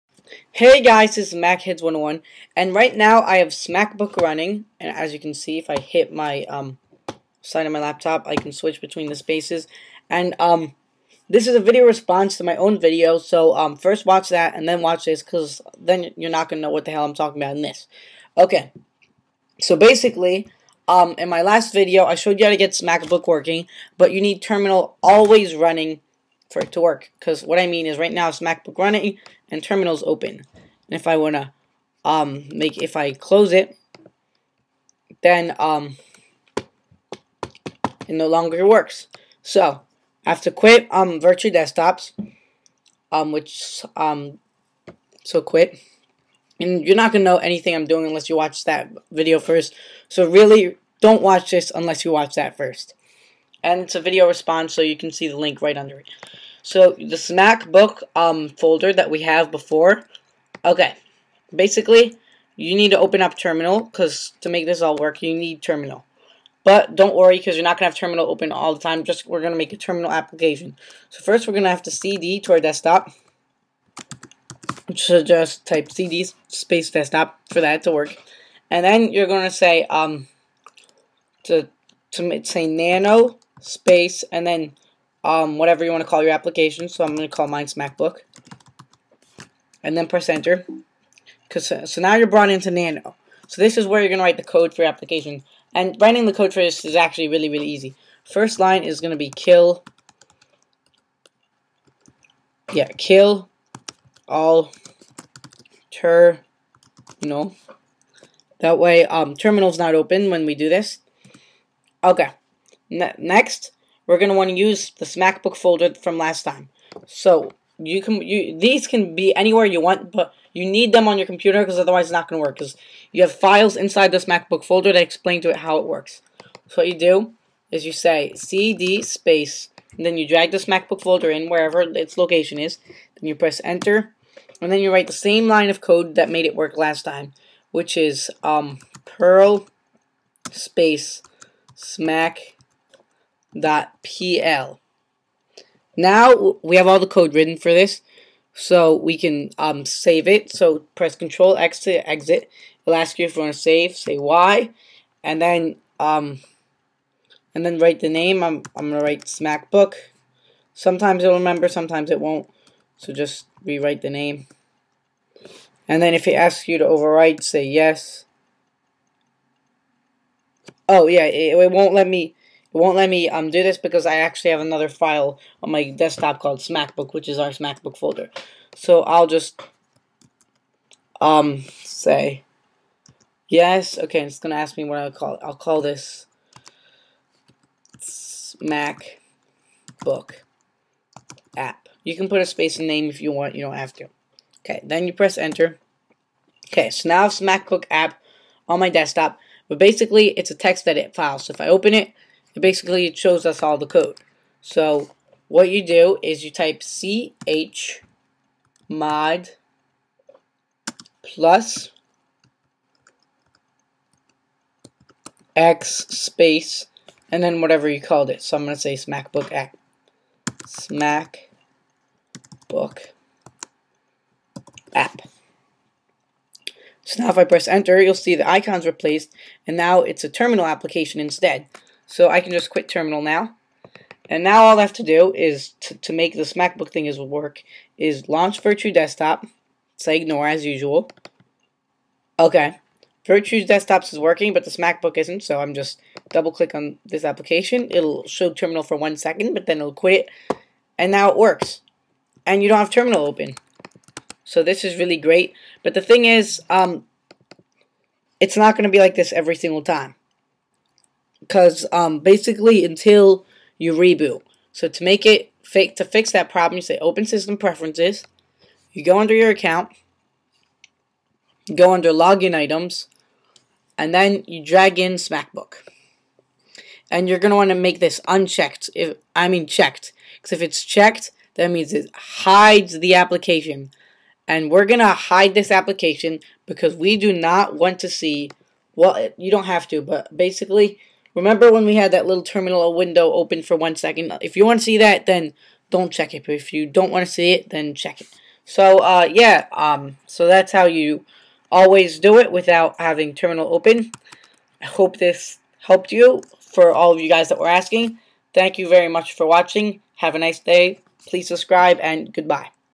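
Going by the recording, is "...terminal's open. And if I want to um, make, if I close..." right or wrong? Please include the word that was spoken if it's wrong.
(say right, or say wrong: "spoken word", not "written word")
right.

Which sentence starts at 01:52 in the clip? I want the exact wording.
Ne next, we're going to want to use the SmackBook folder from last time.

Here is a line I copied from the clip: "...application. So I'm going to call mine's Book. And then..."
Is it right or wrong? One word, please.
wrong.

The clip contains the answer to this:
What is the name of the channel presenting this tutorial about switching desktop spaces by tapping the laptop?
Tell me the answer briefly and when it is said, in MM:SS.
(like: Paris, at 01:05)
MacHeads101, at 00:01.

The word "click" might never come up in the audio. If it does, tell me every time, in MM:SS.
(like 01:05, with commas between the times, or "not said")
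04:06.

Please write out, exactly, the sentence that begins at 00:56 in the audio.
So the Smack Book um, folder that we have before.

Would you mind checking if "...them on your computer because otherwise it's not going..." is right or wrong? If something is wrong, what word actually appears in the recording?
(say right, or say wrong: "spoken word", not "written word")
right.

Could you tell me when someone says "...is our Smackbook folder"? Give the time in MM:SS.
02:57.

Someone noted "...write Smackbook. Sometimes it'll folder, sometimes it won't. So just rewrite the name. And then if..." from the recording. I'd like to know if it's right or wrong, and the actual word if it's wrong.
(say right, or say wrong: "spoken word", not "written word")
wrong: "remember", not "folder".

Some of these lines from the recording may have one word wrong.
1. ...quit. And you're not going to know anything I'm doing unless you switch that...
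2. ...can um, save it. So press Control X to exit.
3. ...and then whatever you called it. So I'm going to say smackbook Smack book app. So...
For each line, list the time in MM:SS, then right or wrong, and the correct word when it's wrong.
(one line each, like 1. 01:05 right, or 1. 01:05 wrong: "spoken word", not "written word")
1. 00:45 wrong: "watch", not "switch"
2. 02:29 right
3. 03:37 right.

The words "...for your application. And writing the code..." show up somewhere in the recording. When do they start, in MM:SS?
01:34.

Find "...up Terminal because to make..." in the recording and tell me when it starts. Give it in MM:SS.
01:03.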